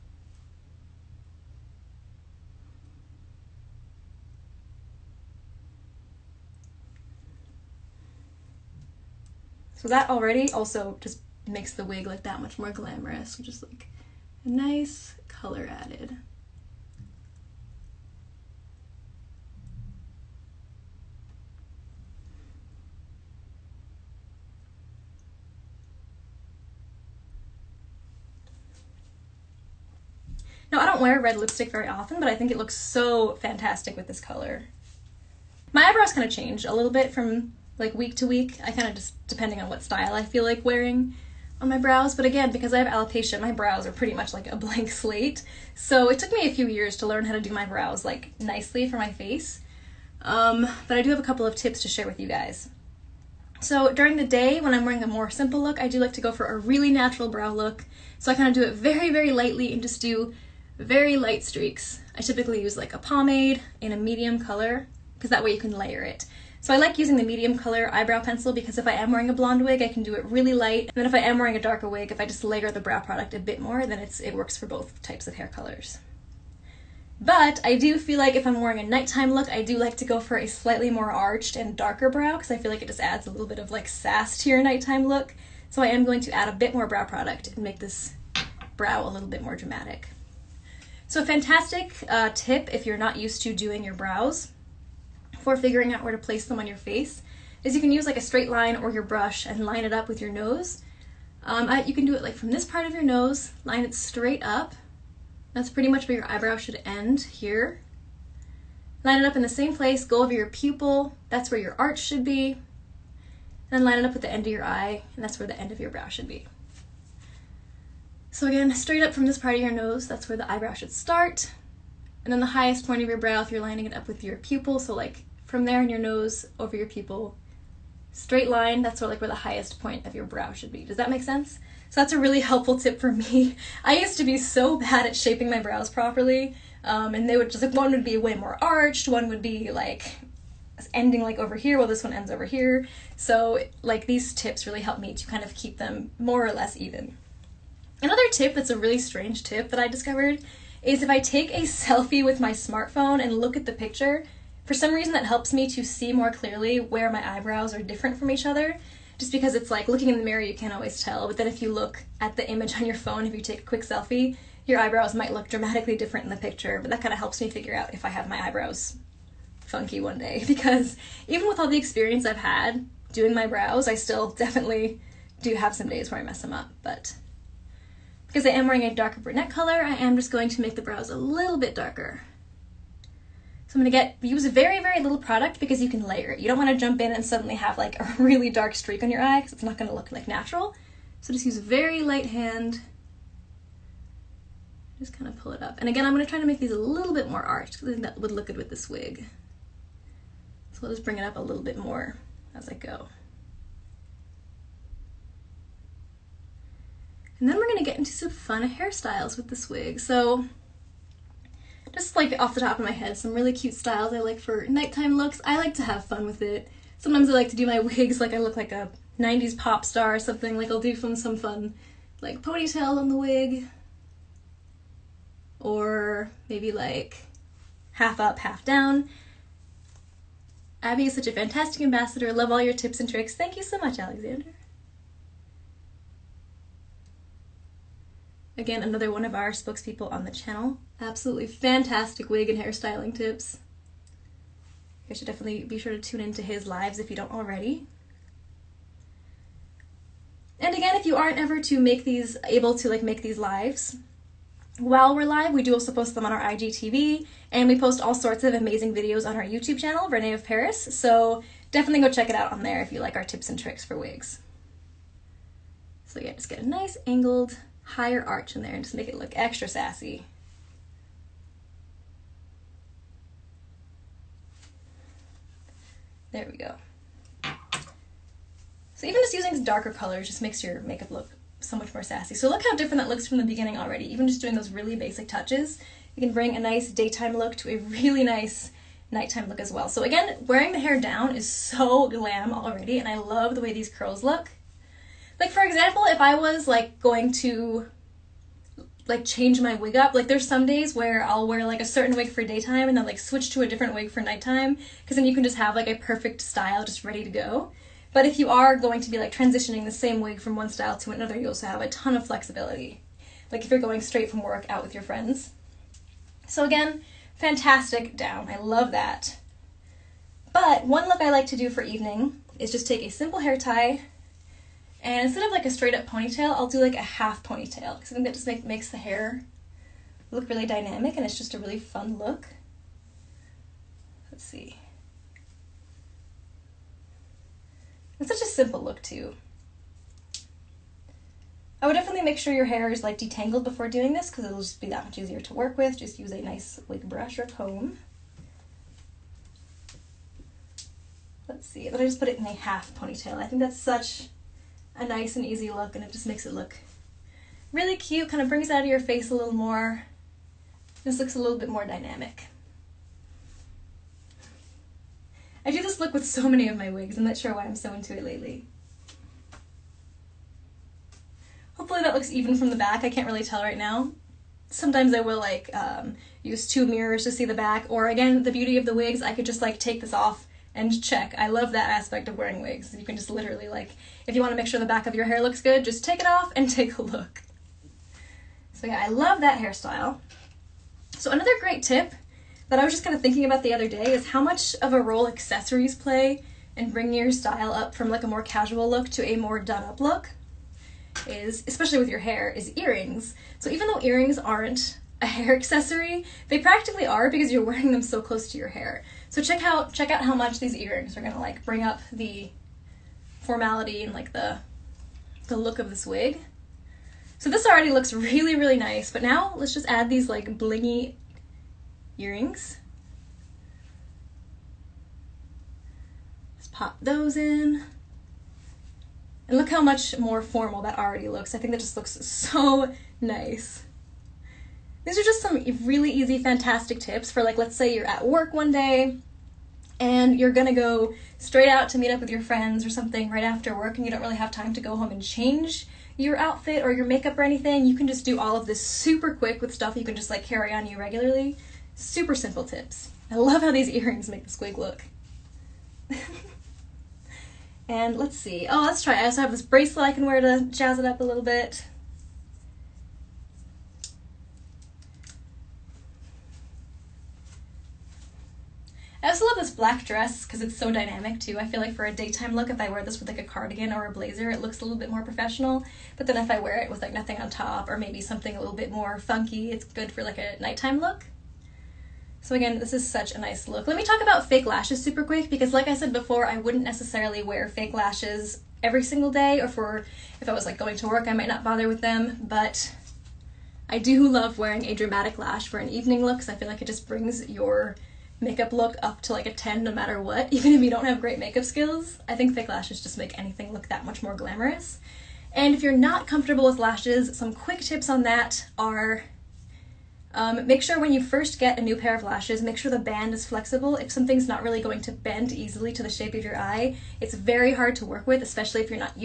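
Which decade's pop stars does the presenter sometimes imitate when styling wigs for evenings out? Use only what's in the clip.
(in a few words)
90s.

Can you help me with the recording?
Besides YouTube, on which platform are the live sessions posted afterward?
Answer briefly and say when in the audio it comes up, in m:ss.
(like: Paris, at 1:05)
IGTV, at 4:16.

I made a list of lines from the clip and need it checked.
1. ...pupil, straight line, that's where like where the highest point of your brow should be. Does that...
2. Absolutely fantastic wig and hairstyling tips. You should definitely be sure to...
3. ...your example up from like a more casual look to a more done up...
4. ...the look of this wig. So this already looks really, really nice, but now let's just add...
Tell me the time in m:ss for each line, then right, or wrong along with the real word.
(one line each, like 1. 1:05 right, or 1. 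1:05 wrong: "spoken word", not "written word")
1. 2:06 right
2. 4:00 right
3. 6:37 wrong: "style", not "example"
4. 6:55 right.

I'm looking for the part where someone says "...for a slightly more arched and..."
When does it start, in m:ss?
1:20.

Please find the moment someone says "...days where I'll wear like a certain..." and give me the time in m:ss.
5:00.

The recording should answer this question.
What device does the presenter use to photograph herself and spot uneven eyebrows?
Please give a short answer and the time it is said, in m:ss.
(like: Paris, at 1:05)
smartphone, at 2:32.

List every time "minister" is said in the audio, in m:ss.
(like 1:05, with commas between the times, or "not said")
not said.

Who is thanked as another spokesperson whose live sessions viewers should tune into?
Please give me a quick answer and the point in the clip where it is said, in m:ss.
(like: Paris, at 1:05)
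Alexander, at 3:53.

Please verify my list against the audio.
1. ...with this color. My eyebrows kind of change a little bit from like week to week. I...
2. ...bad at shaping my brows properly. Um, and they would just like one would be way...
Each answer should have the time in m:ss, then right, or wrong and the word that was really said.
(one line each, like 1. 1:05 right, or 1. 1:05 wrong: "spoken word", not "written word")
1. 0:33 right
2. 2:14 right.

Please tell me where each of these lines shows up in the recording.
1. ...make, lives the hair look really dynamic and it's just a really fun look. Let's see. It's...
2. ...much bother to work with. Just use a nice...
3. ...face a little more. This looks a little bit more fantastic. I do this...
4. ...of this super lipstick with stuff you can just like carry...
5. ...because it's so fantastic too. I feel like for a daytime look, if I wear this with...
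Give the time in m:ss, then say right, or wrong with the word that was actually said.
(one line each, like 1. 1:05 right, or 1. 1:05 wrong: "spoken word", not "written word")
1. 5:28 wrong: "makes", not "lives"
2. 5:45 wrong: "easier", not "bother"
3. 5:58 wrong: "dynamic", not "fantastic"
4. 7:28 wrong: "quick", not "lipstick"
5. 7:50 wrong: "dynamic", not "fantastic".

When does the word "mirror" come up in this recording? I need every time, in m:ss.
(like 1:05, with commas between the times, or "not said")
2:40, 6:16.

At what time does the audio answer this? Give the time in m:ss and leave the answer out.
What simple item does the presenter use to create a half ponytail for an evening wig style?
5:23.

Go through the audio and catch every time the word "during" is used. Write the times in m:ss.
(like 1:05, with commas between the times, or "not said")
0:53.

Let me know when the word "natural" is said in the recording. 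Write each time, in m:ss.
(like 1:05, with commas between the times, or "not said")
0:56, 3:10.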